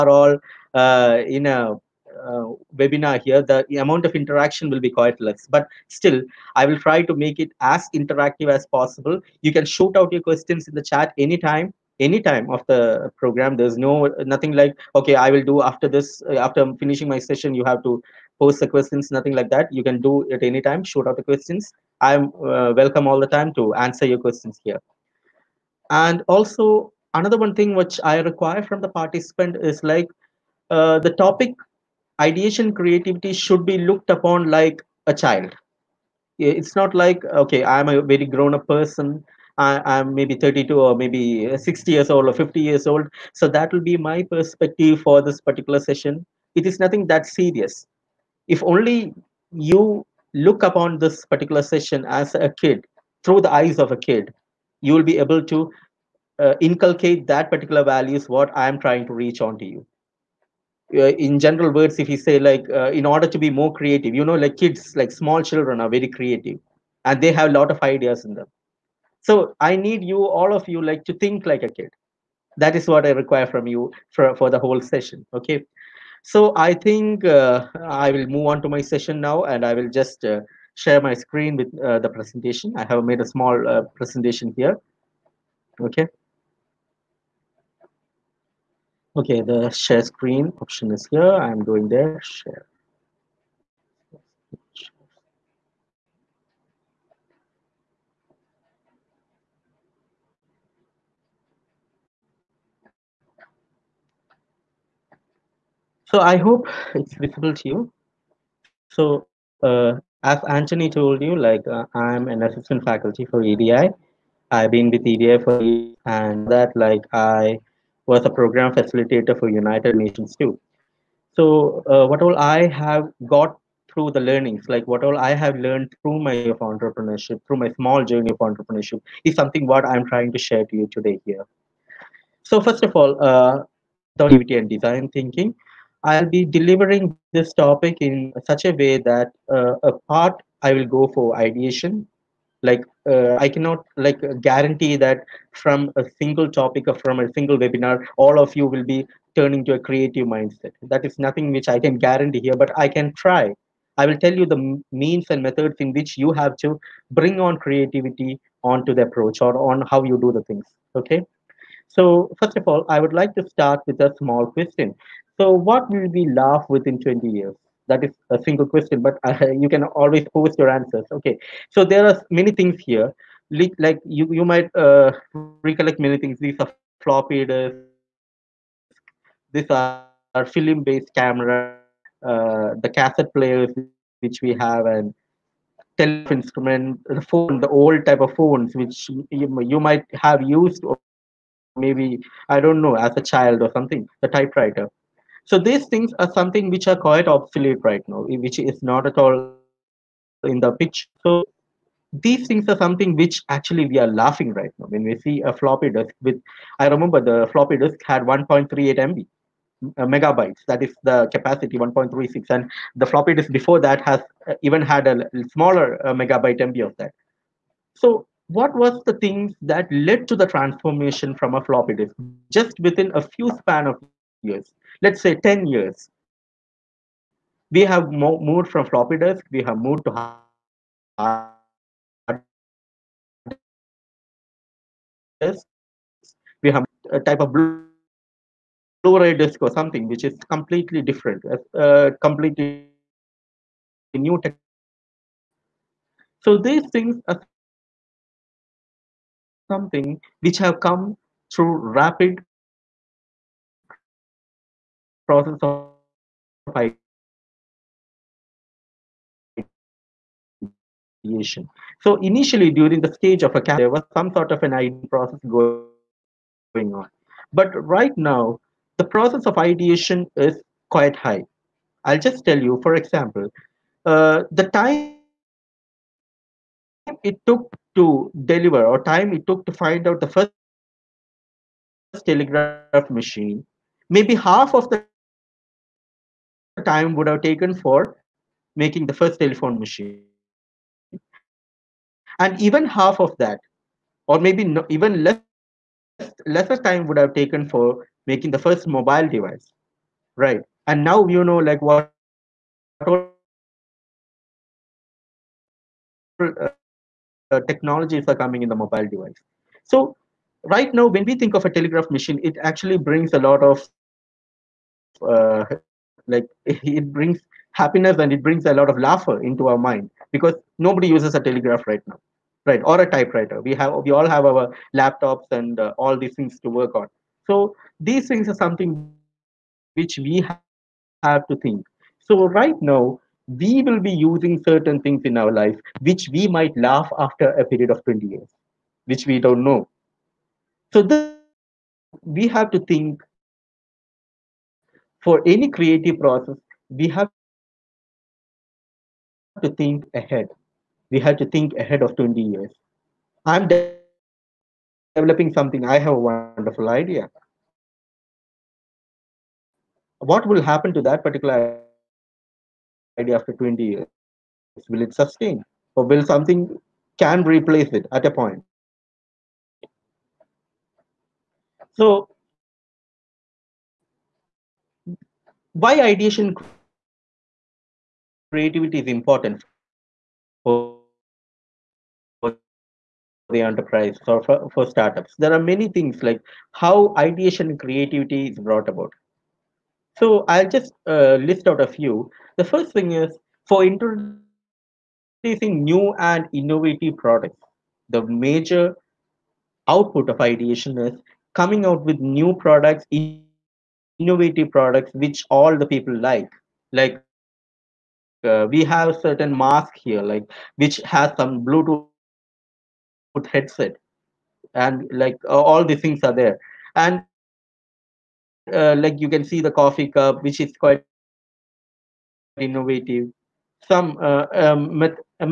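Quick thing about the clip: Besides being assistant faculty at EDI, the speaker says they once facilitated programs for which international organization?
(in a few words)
United Nations.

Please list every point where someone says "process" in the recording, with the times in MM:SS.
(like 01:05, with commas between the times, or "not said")
04:15, 04:25, 04:29, 05:46.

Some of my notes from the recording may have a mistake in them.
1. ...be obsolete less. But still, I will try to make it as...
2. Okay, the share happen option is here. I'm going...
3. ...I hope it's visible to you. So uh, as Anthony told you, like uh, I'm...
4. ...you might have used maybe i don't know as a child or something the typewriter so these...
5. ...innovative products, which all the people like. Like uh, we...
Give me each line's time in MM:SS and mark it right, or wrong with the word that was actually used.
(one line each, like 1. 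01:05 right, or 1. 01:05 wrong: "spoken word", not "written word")
1. 00:04 wrong: "quite", not "obsolete"
2. 01:29 wrong: "screen", not "happen"
3. 01:46 right
4. 03:09 right
5. 06:44 right.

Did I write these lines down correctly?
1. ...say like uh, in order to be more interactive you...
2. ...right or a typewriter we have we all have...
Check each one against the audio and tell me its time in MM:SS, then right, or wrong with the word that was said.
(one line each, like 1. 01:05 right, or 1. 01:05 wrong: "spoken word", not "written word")
1. 01:02 wrong: "creative", not "interactive"
2. 05:22 right.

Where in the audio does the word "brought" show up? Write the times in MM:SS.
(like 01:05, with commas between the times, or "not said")
06:28.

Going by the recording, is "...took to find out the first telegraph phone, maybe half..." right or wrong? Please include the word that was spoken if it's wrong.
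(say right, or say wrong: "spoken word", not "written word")
wrong: "machine", not "phone".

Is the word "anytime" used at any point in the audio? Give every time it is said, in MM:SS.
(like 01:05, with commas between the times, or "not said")
00:11, 00:20.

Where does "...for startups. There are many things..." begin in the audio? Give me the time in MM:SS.
06:24.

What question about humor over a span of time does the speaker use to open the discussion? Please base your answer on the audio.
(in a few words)
What will we laugh within 20 years.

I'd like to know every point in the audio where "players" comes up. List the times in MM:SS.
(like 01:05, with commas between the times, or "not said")
03:03.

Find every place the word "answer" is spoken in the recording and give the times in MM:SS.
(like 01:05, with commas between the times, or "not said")
00:23, 02:50.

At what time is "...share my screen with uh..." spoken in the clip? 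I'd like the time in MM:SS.
01:20.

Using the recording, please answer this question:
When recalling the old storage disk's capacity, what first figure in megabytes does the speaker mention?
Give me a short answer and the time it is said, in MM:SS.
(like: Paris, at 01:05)
1.38 MB, at 03:28.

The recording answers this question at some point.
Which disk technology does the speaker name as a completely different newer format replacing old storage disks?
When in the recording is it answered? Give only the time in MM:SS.
03:57.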